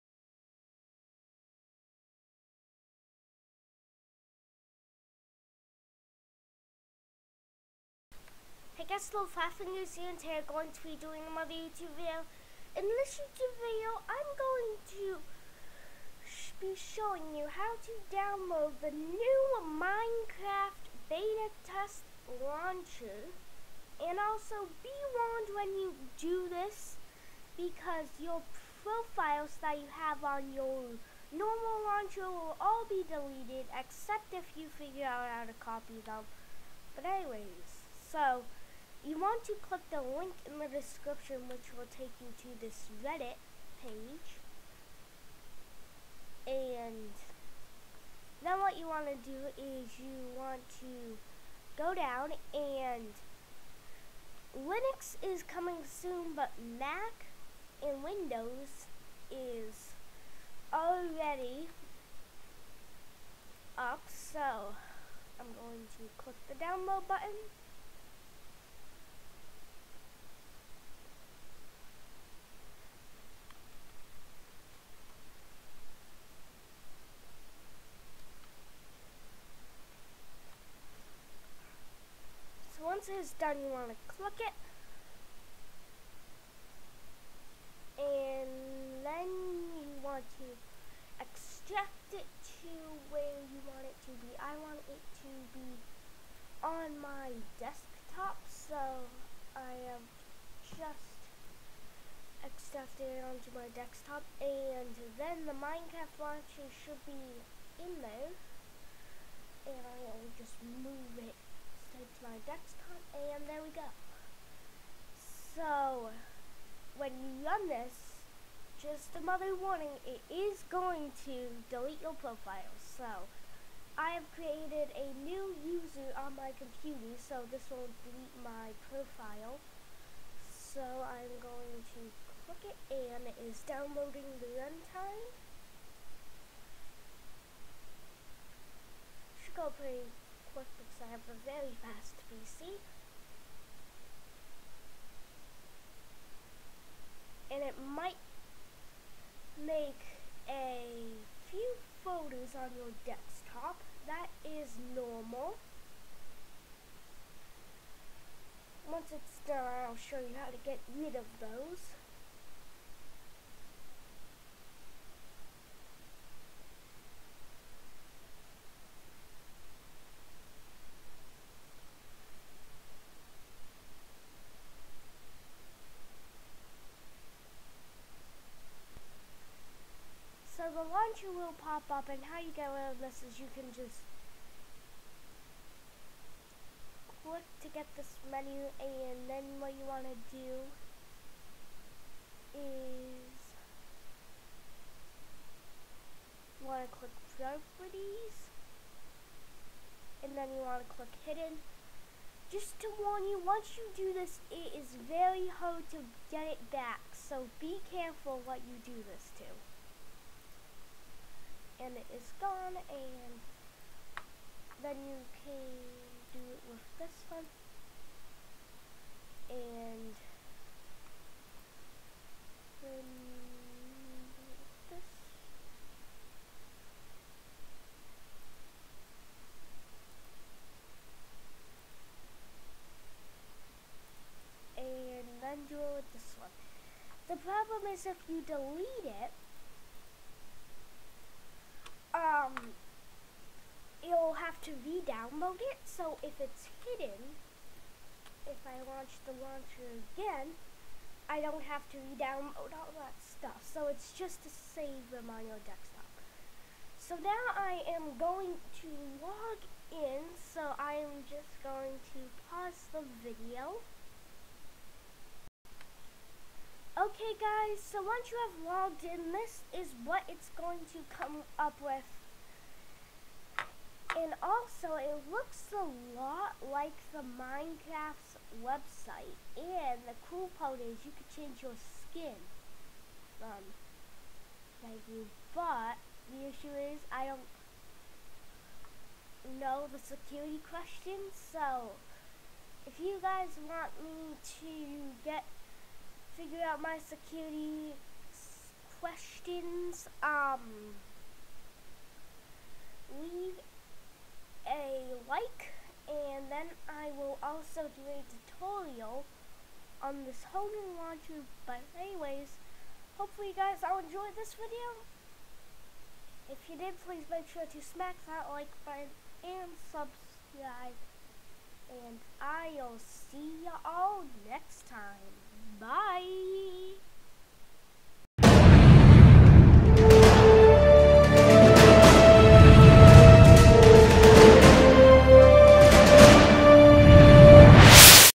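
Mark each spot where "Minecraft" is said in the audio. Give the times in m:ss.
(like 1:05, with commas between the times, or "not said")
0:19, 1:45, 4:37.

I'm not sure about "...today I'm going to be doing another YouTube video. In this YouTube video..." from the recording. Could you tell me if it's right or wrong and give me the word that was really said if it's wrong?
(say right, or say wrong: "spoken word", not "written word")
right.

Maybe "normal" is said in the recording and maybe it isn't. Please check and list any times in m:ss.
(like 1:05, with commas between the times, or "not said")
0:31, 2:34.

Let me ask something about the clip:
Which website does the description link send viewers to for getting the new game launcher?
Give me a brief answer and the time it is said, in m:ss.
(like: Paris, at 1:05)
Reddit, at 0:43.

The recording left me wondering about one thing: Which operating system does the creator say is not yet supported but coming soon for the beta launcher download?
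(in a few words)
Linux.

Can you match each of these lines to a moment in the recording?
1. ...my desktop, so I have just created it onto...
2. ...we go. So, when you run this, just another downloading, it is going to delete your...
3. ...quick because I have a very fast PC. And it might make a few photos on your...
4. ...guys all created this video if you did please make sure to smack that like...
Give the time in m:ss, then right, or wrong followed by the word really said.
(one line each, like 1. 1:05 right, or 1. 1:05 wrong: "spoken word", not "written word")
1. 1:37 wrong: "extracted", not "created"
2. 1:53 wrong: "warning", not "downloading"
3. 2:20 right
4. 5:13 wrong: "enjoyed", not "created".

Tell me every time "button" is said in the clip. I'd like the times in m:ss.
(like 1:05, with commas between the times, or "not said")
1:07, 5:18.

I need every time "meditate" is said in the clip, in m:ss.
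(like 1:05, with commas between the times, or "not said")
not said.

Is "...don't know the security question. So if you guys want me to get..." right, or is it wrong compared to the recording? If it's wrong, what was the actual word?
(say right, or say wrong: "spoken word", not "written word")
right.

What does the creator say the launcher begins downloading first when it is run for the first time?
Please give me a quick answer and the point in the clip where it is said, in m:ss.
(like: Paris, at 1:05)
The runtime, at 2:14.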